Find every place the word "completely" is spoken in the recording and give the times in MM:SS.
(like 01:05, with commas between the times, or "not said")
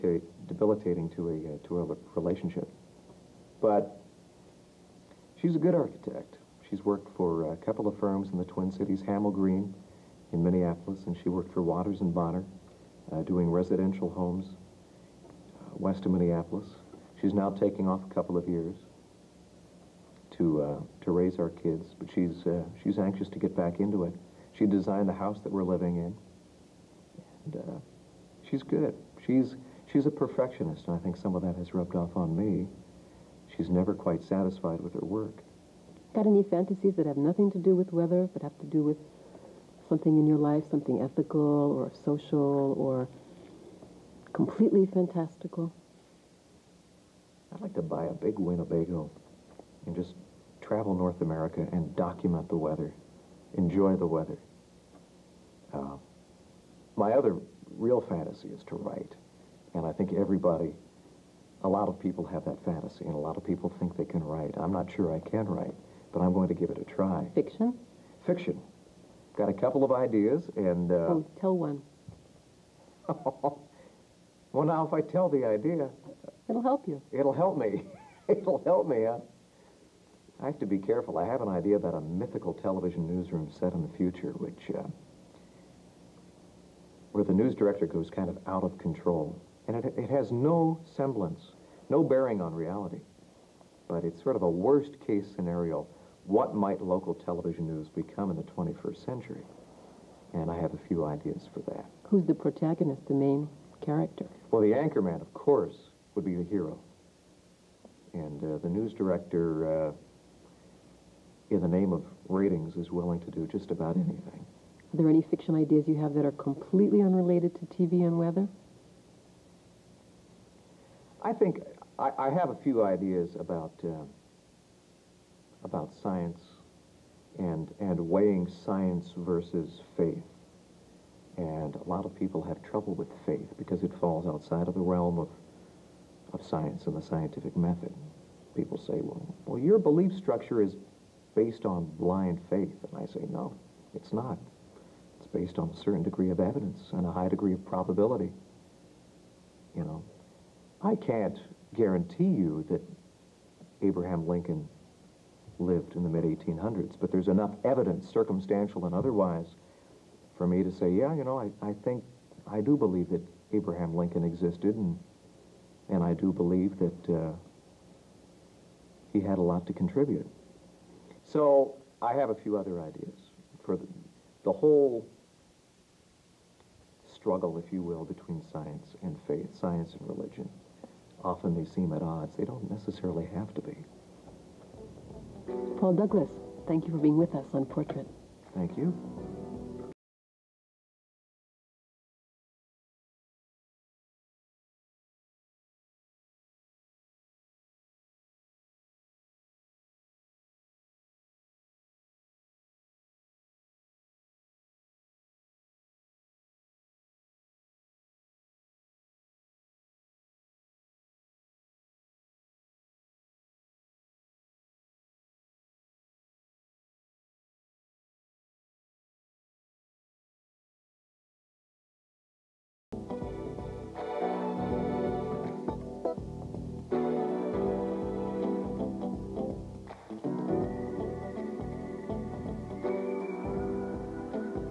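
00:44, 01:56.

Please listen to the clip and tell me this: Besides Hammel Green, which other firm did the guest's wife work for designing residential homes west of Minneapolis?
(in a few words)
Waters and Bonner.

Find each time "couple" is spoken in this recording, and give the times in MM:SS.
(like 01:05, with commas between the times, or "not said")
00:07, 00:18, 01:09.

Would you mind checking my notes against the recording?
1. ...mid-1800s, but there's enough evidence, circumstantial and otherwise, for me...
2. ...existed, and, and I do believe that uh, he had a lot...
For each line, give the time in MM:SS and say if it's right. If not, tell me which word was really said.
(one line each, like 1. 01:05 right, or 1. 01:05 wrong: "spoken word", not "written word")
1. 02:36 right
2. 02:44 right.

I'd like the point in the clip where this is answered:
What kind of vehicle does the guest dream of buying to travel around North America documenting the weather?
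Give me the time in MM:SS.
00:48.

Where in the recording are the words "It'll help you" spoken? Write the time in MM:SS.
01:16.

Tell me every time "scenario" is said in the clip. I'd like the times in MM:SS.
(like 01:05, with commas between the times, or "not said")
01:35.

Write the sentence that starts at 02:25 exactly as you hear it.
It's based on a certain degree of evidence and a high degree of probability.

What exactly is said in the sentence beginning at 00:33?
She's never quite satisfied with her work.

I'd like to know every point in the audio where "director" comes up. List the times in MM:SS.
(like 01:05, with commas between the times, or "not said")
01:27, 01:48.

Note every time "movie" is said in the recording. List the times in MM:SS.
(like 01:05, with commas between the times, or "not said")
not said.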